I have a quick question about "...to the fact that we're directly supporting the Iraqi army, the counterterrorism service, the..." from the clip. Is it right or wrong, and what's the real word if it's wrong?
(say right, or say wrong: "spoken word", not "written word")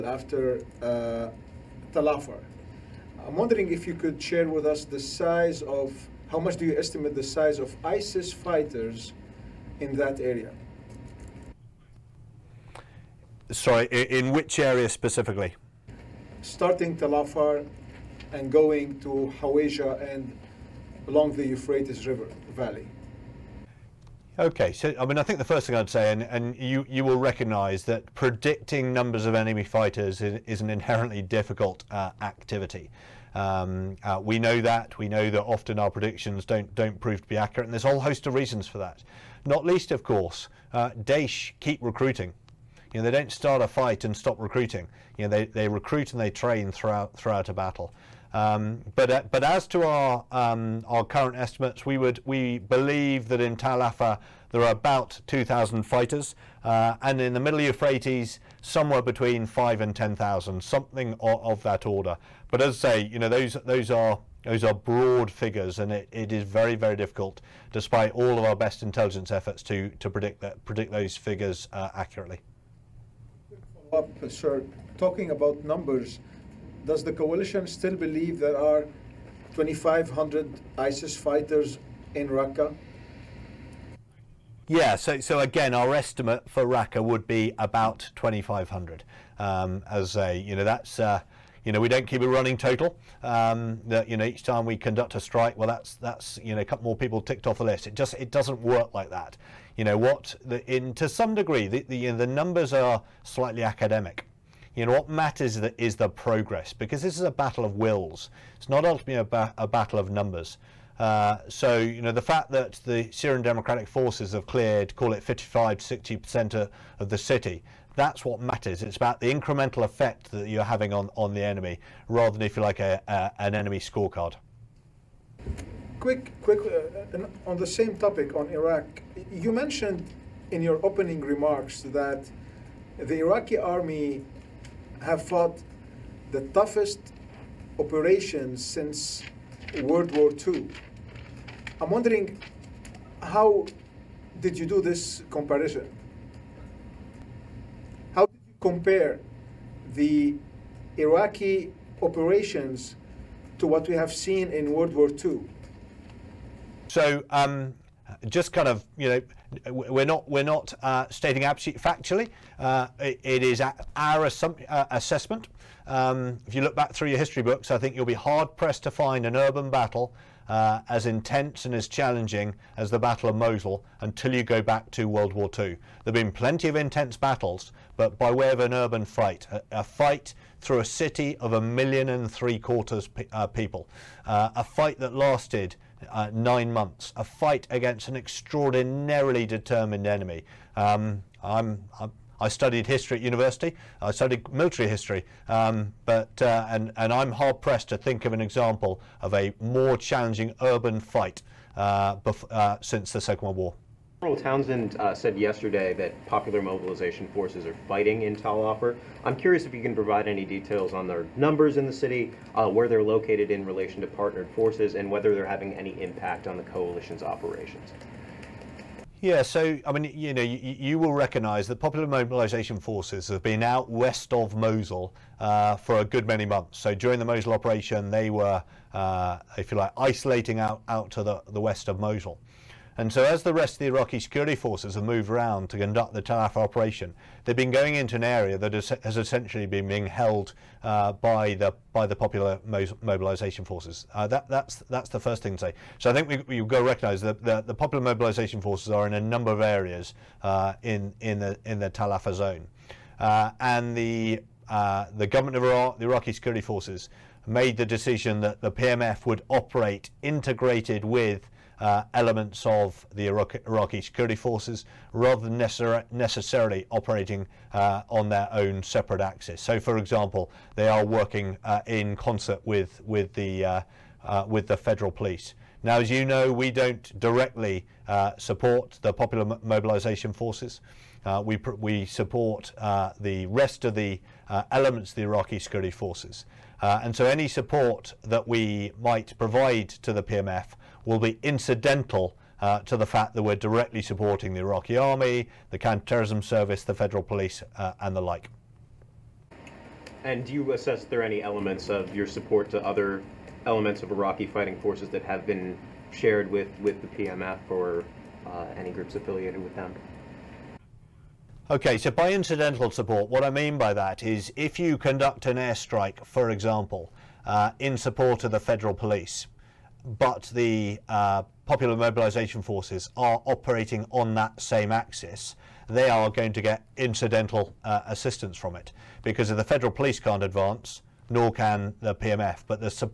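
right.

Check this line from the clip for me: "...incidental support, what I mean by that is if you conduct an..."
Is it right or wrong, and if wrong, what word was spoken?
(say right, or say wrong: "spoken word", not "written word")
right.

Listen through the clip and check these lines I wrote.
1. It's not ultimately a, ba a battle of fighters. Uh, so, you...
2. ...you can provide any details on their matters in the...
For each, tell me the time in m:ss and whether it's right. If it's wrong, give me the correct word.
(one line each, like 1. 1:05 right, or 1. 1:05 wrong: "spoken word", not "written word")
1. 1:48 wrong: "numbers", not "fighters"
2. 3:29 wrong: "numbers", not "matters".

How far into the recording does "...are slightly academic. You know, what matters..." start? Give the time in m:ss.
1:42.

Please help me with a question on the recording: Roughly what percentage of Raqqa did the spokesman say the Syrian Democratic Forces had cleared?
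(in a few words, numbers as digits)
55 to 60%.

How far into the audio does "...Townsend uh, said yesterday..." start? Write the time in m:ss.
3:24.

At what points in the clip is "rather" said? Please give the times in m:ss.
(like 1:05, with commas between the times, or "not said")
2:02, 4:25.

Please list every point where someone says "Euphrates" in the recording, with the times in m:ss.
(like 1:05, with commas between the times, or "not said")
0:21, 0:57.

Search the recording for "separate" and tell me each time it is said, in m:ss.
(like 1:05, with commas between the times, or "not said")
4:28.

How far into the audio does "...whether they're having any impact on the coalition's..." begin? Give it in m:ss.
3:35.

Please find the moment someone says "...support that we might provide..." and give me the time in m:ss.
4:47.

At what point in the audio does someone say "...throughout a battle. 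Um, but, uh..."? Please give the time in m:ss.
0:47.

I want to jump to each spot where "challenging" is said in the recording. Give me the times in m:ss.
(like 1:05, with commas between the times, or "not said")
2:51, 3:19.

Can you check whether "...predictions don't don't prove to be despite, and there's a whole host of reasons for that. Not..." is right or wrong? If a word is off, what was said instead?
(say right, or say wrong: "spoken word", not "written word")
wrong: "accurate", not "despite".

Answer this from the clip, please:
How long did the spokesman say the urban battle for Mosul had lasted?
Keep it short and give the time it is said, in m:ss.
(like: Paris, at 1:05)
9 months, at 3:06.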